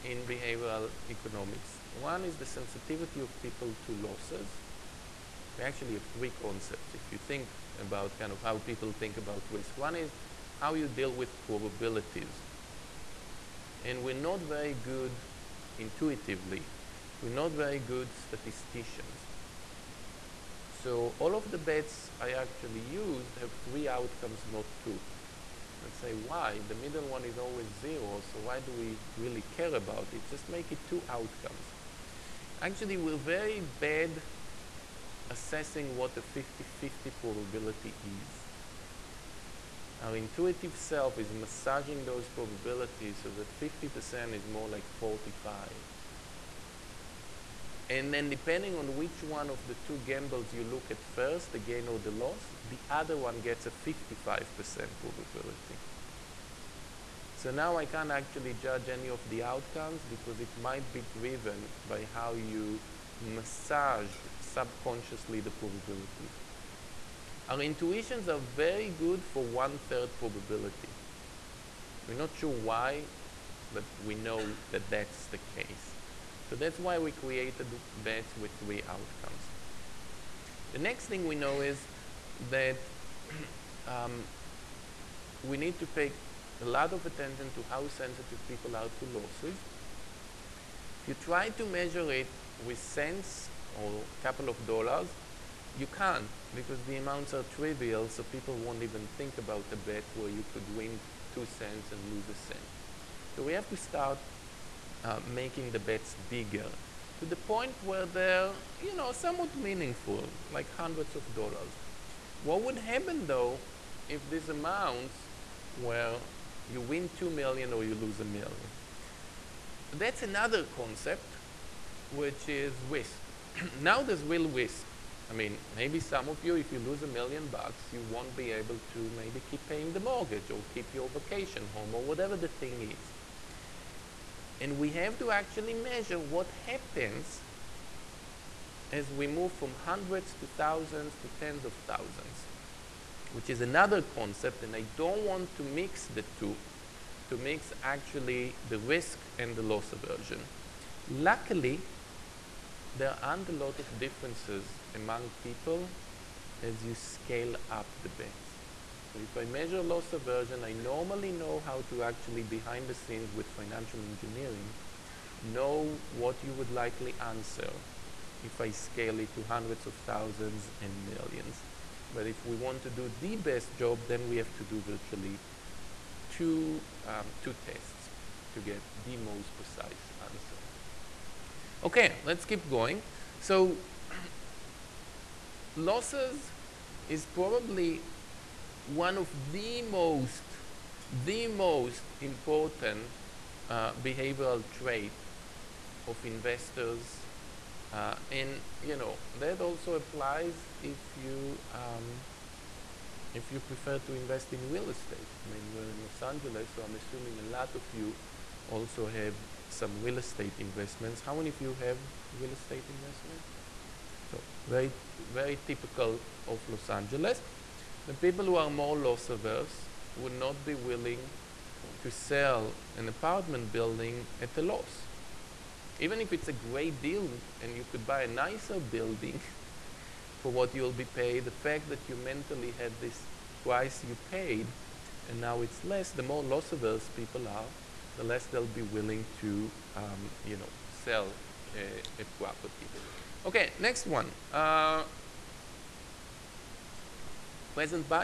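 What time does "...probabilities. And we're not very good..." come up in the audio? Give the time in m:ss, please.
0:11.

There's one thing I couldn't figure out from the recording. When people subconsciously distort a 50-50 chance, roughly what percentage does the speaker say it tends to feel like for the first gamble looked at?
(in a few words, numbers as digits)
45.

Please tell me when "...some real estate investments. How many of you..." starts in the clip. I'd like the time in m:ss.
3:29.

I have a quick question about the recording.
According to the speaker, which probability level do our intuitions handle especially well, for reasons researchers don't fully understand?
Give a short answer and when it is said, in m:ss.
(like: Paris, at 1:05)
one third, at 1:09.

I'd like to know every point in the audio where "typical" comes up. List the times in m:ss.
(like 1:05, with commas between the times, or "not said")
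3:35.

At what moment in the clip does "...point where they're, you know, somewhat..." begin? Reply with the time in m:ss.
1:47.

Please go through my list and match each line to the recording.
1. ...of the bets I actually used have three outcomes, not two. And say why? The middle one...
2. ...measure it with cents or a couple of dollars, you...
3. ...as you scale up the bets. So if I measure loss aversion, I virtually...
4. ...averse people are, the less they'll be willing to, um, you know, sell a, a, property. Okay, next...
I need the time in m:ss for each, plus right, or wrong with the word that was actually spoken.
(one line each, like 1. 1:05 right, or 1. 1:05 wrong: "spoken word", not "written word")
1. 0:21 right
2. 1:31 right
3. 2:36 wrong: "normally", not "virtually"
4. 3:56 right.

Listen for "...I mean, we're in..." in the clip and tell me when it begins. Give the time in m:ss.
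3:25.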